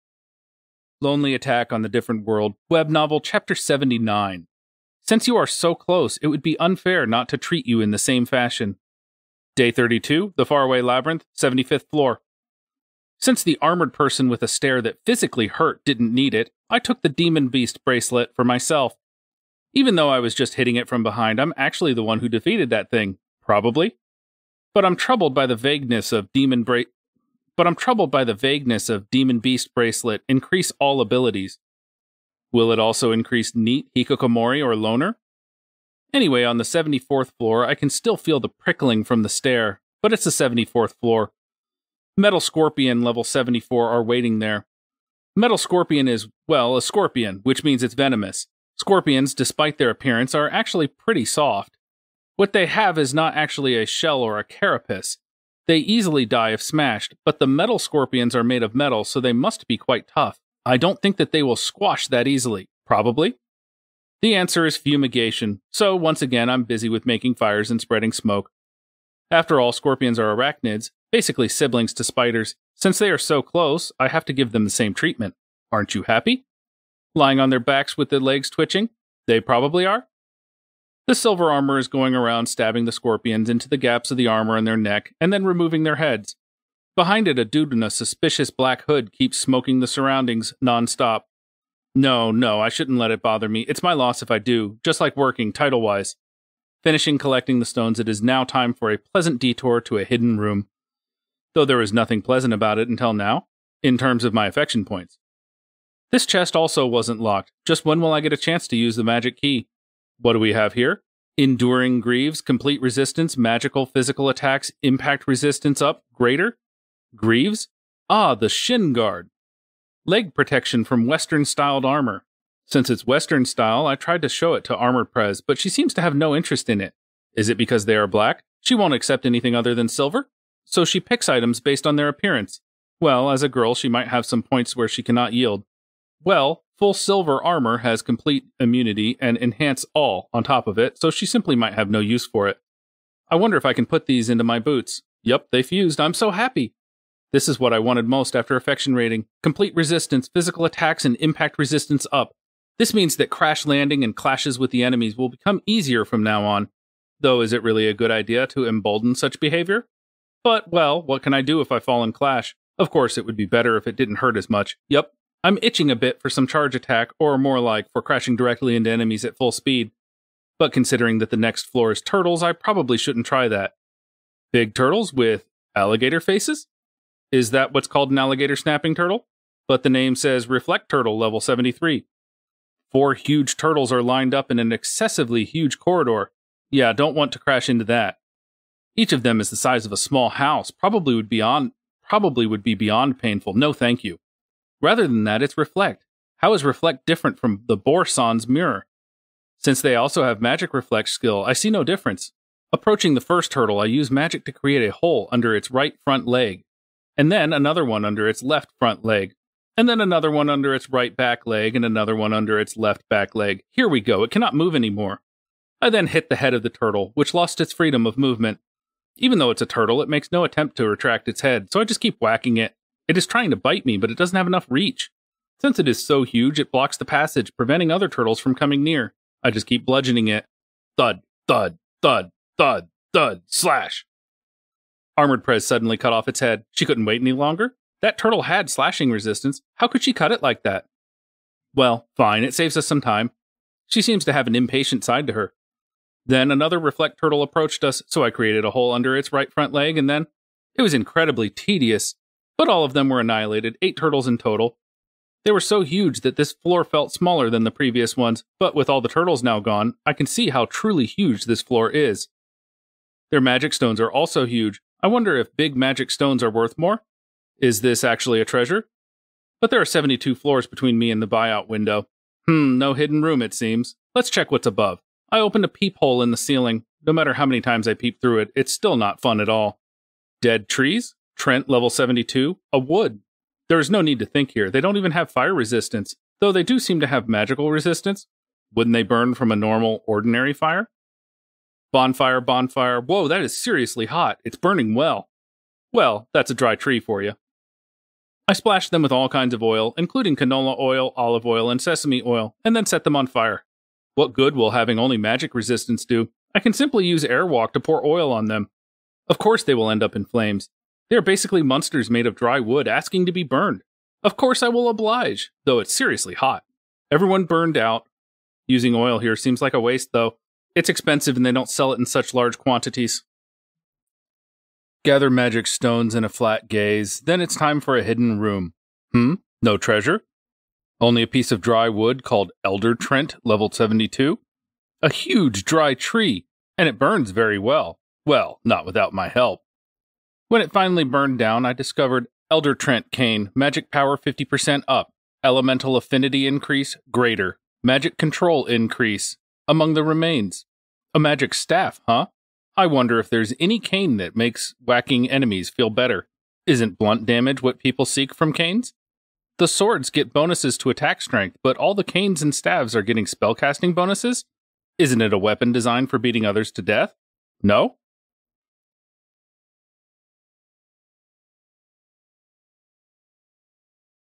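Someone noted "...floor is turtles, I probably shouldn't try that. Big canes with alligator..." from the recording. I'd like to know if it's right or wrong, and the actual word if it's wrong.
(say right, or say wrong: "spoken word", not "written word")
wrong: "turtles", not "canes".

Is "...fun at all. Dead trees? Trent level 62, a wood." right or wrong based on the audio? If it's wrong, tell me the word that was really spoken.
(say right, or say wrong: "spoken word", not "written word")
wrong: "72", not "62".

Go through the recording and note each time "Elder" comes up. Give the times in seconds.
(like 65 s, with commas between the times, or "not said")
332 s, 342 s.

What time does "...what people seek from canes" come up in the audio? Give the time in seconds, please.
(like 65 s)
357 s.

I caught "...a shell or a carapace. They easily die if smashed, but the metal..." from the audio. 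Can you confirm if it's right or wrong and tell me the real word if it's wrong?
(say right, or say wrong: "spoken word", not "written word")
right.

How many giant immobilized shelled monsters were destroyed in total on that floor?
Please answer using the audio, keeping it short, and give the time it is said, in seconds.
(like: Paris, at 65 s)
8, at 253 s.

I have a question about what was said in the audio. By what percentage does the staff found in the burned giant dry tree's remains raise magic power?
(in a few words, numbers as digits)
50%.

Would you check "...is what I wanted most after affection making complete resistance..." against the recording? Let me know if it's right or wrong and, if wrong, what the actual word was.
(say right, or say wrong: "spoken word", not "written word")
wrong: "rating", not "making".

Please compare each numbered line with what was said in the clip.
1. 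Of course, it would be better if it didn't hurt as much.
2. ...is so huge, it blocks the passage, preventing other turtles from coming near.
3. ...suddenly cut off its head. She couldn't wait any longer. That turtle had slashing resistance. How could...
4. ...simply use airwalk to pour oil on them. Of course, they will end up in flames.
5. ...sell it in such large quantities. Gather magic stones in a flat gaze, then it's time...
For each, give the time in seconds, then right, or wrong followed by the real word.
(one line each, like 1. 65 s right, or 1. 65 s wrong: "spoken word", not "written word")
1. 162 s right
2. 225 s right
3. 235 s right
4. 306 s right
5. 321 s right.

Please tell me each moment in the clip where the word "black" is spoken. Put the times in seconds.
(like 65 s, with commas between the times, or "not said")
88 s, 128 s.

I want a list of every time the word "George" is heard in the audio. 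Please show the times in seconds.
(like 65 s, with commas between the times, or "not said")
not said.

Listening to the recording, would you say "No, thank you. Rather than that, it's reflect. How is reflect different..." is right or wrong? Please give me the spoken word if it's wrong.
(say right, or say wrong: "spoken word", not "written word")
right.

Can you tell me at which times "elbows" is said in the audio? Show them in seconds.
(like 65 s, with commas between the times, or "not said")
not said.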